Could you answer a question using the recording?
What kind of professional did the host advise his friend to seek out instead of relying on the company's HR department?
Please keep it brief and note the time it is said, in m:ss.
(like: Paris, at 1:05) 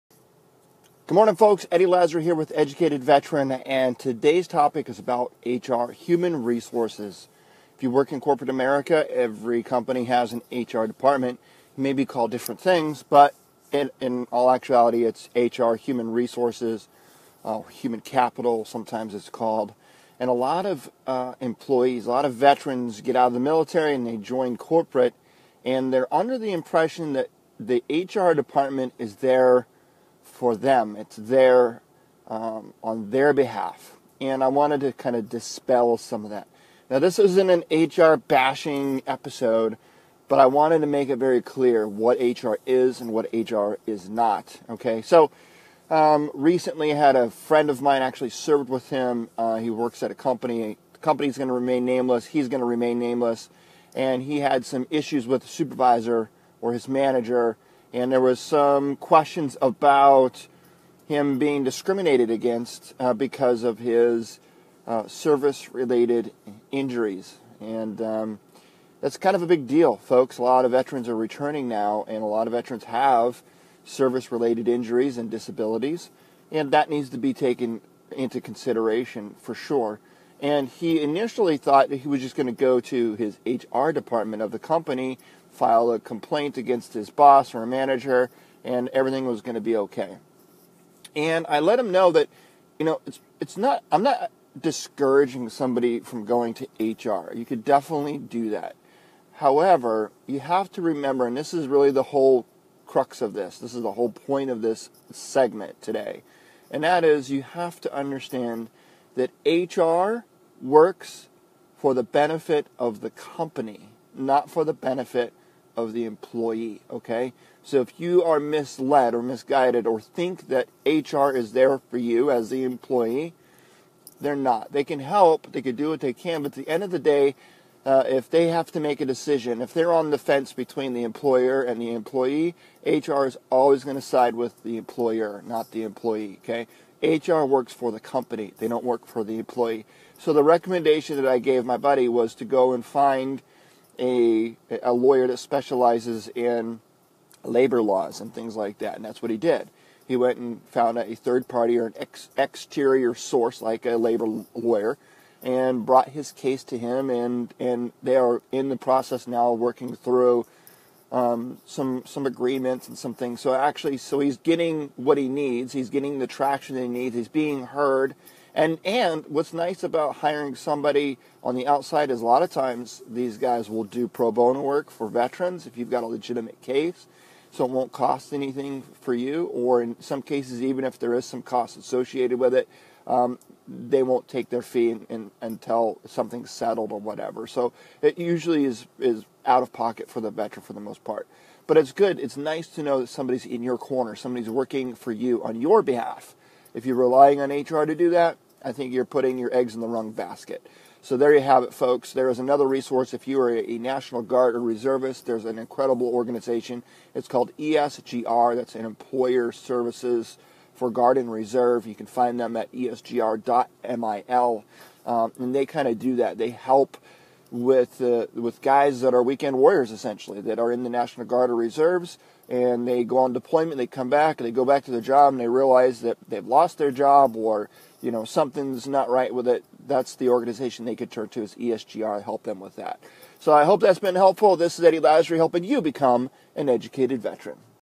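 labor lawyer, at 2:33.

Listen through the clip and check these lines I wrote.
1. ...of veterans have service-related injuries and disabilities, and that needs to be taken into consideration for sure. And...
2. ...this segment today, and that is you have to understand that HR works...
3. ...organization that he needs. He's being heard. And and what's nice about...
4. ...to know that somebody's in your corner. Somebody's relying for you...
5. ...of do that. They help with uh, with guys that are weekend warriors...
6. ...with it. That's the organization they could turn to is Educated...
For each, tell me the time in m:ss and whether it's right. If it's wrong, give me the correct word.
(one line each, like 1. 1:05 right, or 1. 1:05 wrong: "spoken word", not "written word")
1. 1:12 right
2. 1:44 right
3. 2:46 wrong: "traction", not "organization"
4. 3:12 wrong: "working", not "relying"
5. 3:35 right
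6. 3:49 wrong: "ESGR", not "Educated".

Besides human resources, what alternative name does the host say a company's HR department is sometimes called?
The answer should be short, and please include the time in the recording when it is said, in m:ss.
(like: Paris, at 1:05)
human capital, at 0:17.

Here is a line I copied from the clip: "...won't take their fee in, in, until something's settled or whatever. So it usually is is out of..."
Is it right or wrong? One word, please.
right.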